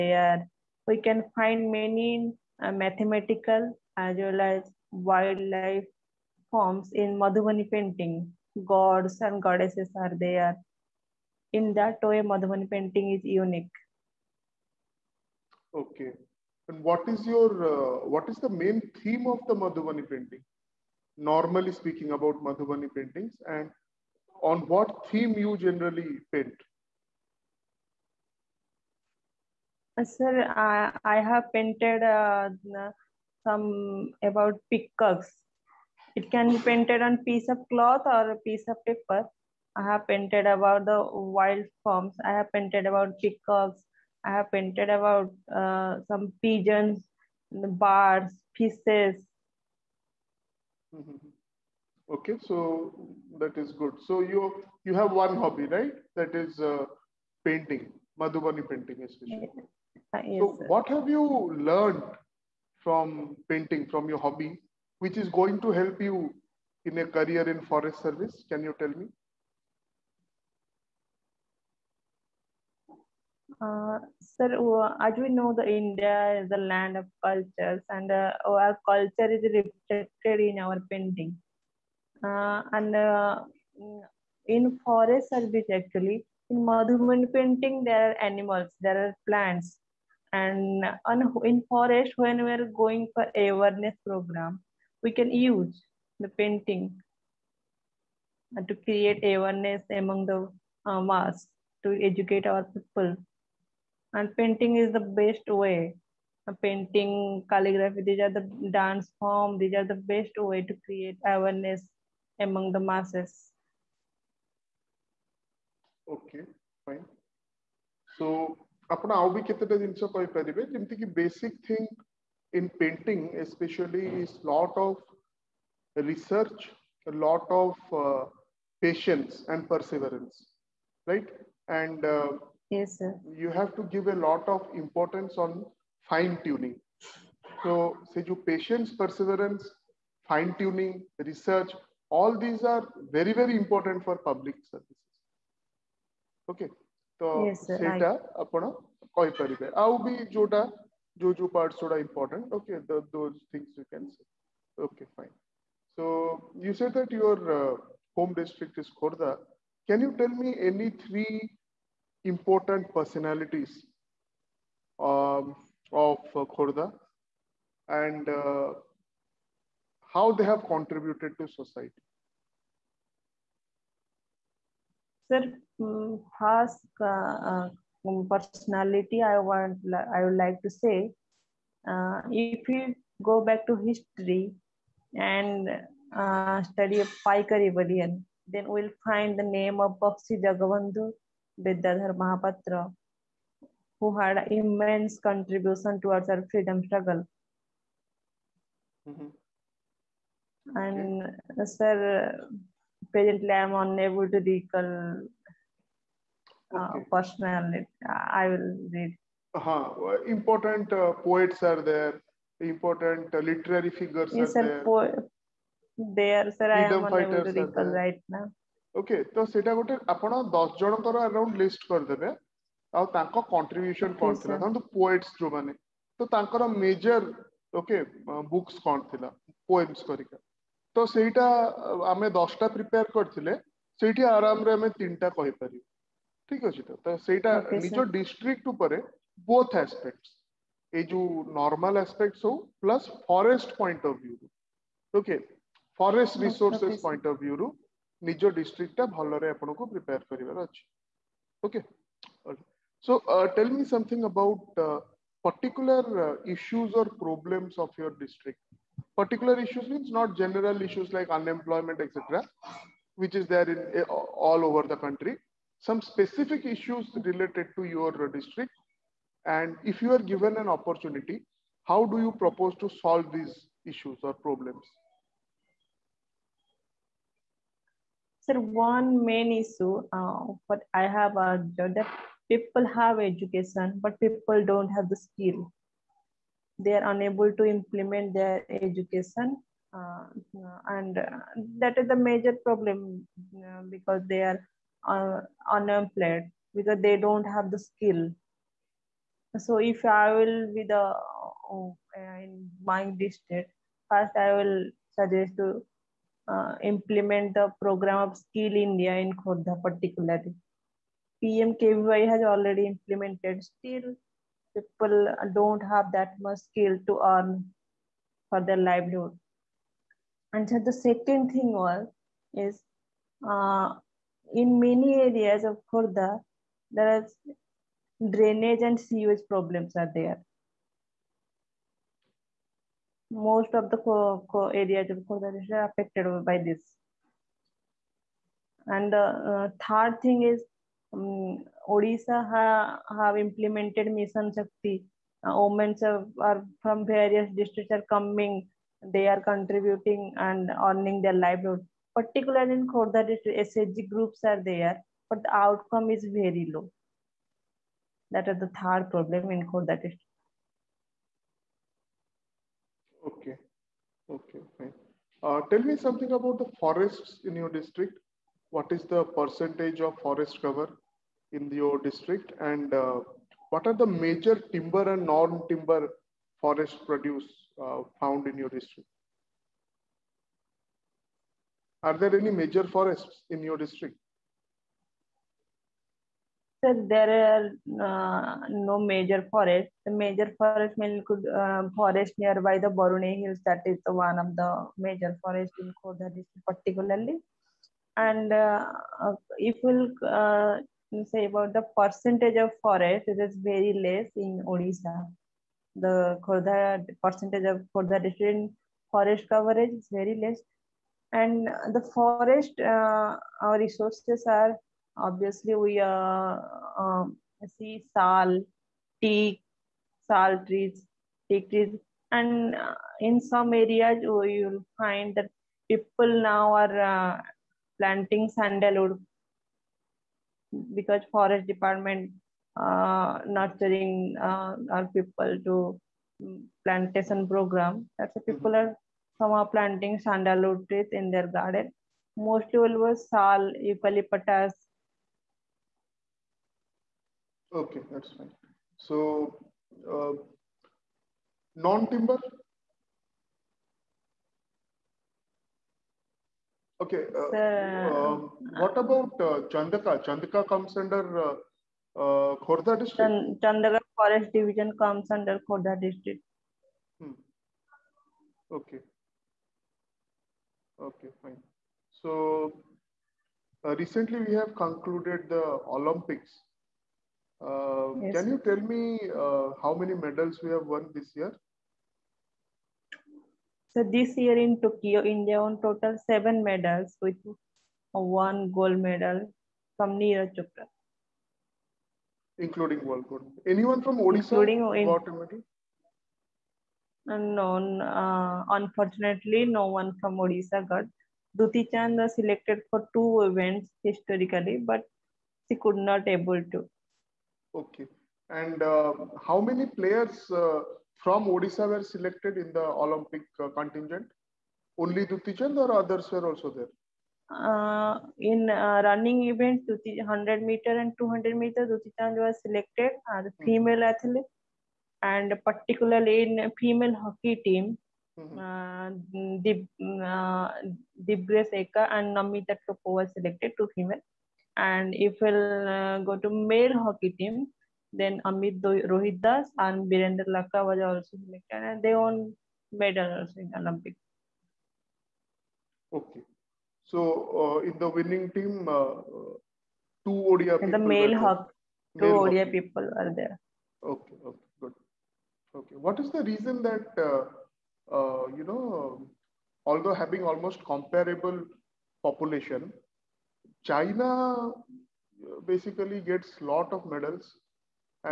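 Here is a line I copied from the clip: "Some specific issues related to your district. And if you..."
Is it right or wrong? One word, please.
right.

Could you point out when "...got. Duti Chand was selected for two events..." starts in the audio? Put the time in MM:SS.
08:20.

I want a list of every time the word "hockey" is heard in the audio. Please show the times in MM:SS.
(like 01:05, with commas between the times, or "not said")
08:47, 08:57, 09:11.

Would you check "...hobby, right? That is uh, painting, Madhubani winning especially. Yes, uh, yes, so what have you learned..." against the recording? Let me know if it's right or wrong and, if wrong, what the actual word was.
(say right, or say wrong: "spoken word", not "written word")
wrong: "painting", not "winning".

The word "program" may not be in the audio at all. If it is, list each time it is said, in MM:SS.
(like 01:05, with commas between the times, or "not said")
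01:34, 05:07, 07:17.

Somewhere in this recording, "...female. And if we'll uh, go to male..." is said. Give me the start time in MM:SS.
08:53.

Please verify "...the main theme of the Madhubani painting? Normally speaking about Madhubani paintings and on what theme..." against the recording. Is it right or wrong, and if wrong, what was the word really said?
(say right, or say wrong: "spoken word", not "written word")
right.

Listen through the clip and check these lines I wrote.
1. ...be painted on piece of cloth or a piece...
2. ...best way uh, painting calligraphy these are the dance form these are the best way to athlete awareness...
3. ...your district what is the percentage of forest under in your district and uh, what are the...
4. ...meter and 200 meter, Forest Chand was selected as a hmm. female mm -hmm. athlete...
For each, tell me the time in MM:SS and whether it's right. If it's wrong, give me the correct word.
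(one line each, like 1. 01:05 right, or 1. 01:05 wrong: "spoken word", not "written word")
1. 00:36 right
2. 01:45 wrong: "create", not "athlete"
3. 06:07 wrong: "cover", not "under"
4. 08:40 wrong: "Duti", not "Forest".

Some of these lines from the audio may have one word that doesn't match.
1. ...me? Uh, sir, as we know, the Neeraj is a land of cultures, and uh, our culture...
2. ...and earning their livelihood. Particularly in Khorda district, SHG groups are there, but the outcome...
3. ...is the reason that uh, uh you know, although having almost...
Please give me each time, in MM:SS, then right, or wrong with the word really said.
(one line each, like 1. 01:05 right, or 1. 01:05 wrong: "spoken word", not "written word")
1. 01:08 wrong: "India", not "Neeraj"
2. 05:50 right
3. 09:16 right.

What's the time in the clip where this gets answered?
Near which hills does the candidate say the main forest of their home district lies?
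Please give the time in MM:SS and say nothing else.
06:32.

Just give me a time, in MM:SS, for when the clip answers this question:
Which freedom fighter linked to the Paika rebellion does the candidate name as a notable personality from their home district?
03:10.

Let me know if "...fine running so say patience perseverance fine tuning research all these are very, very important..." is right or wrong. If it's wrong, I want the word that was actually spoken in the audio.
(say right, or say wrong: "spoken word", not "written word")
wrong: "tuning", not "running".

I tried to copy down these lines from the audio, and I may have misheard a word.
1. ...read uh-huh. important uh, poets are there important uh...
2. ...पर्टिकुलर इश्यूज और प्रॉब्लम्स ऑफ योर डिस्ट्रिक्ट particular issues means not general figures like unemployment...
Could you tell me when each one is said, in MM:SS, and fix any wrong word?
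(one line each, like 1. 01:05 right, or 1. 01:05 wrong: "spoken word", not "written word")
1. 03:28 right
2. 04:15 wrong: "issues", not "figures".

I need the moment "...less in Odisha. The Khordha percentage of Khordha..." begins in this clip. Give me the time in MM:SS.
06:43.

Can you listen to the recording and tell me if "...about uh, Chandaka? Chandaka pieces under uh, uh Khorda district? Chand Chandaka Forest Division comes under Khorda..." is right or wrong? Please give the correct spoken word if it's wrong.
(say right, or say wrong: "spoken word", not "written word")
wrong: "comes", not "pieces".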